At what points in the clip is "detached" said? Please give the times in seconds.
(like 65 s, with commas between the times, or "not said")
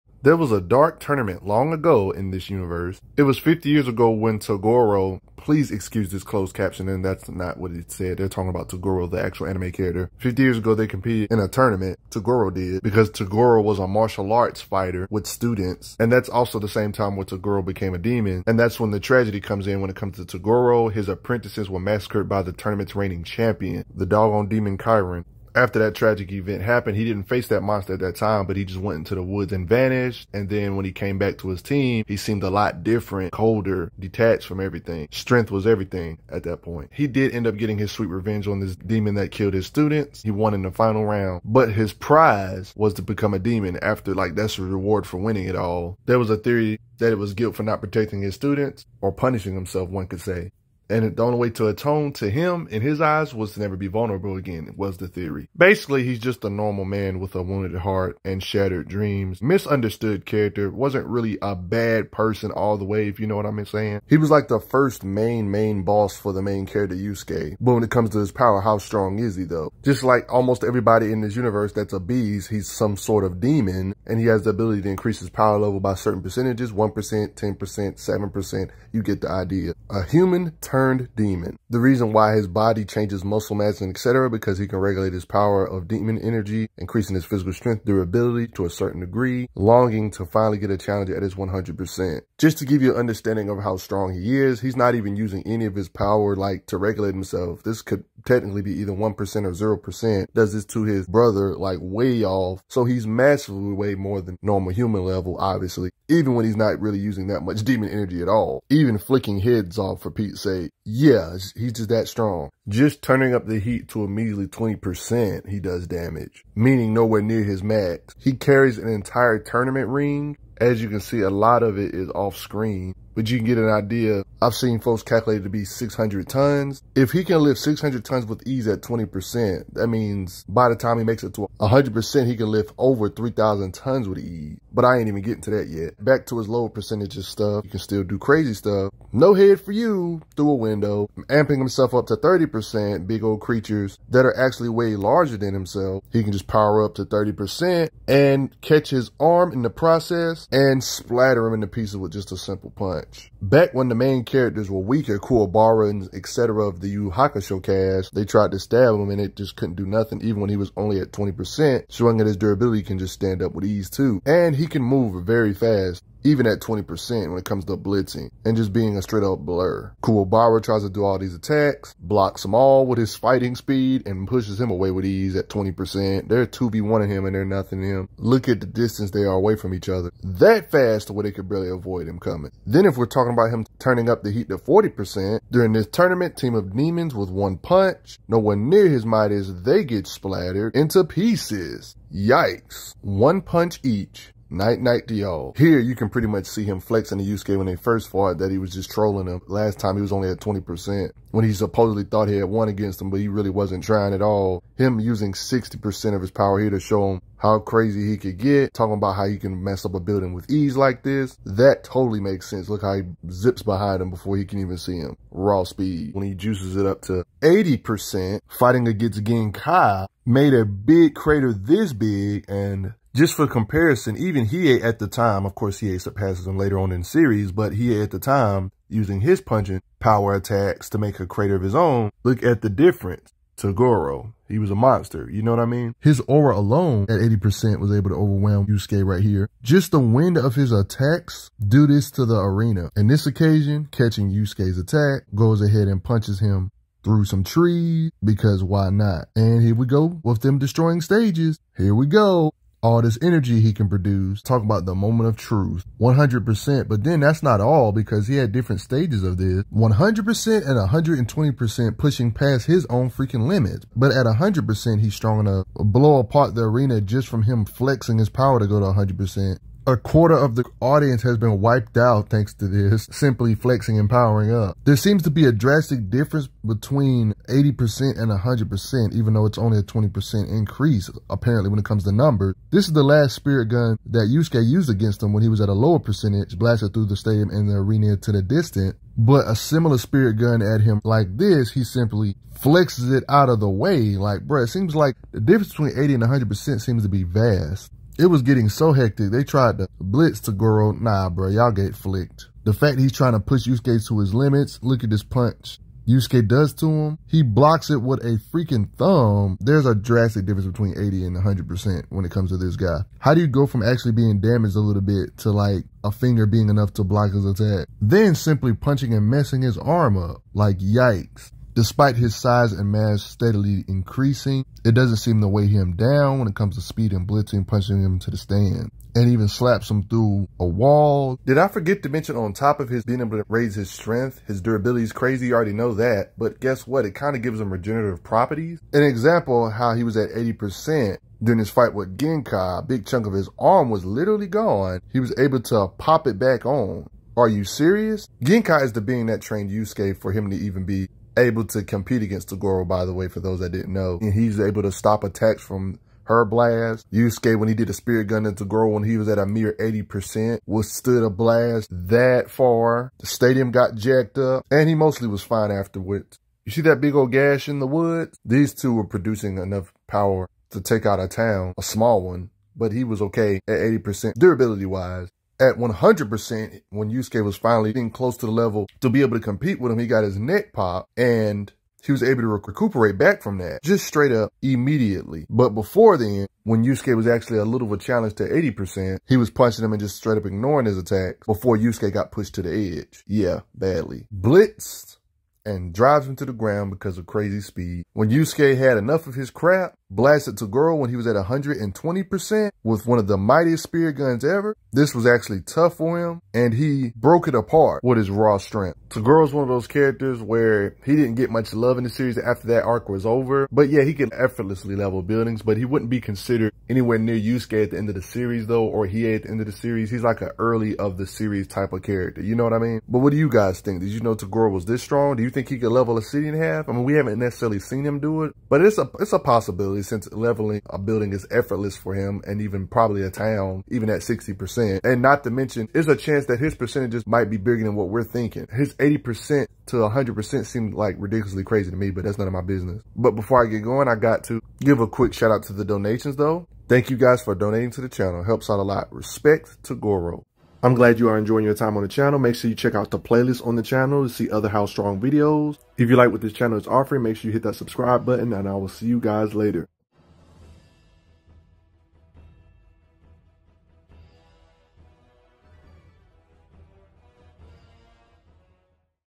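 33 s.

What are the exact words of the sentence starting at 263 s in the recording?
But at 100%, he's strong enough to blow apart the arena just from him flexing his power to go to 100%.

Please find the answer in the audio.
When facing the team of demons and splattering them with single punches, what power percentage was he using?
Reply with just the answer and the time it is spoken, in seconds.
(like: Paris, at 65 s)
40%, at 184 s.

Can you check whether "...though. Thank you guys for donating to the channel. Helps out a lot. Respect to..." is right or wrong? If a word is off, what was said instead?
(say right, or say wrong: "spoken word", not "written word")
right.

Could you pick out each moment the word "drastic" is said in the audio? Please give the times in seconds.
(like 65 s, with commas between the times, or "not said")
275 s, 309 s.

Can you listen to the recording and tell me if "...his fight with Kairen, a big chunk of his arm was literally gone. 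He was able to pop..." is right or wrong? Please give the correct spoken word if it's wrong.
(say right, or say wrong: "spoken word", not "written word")
wrong: "Genkai", not "Kairen".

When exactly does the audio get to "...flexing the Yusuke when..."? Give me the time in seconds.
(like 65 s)
196 s.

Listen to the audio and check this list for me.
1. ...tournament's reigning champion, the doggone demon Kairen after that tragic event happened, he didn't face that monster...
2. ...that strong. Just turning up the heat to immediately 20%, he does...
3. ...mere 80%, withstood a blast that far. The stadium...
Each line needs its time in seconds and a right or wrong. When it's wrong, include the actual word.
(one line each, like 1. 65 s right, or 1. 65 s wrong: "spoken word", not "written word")
1. 22 s right
2. 111 s right
3. 359 s right.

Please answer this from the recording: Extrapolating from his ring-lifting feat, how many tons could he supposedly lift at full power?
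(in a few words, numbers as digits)
3,000 tons.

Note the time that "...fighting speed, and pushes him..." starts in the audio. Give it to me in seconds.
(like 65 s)
173 s.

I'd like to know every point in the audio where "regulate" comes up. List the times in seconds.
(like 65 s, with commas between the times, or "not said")
84 s, 96 s.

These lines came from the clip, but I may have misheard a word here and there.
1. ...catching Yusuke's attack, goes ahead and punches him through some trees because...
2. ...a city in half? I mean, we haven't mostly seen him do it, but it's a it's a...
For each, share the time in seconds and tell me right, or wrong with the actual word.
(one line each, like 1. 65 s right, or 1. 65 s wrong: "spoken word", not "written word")
1. 243 s right
2. 426 s wrong: "necessarily", not "mostly".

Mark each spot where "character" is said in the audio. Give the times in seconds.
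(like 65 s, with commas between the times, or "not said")
9 s, 60 s, 66 s, 154 s, 409 s, 422 s.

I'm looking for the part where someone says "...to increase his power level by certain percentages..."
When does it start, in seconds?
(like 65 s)
74 s.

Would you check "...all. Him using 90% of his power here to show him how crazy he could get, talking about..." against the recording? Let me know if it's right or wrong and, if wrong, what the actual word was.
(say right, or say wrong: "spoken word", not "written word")
wrong: "60", not "90".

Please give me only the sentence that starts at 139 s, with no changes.
No head for you through a window.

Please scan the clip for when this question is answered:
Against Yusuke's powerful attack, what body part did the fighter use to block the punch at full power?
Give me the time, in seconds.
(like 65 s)
308 s.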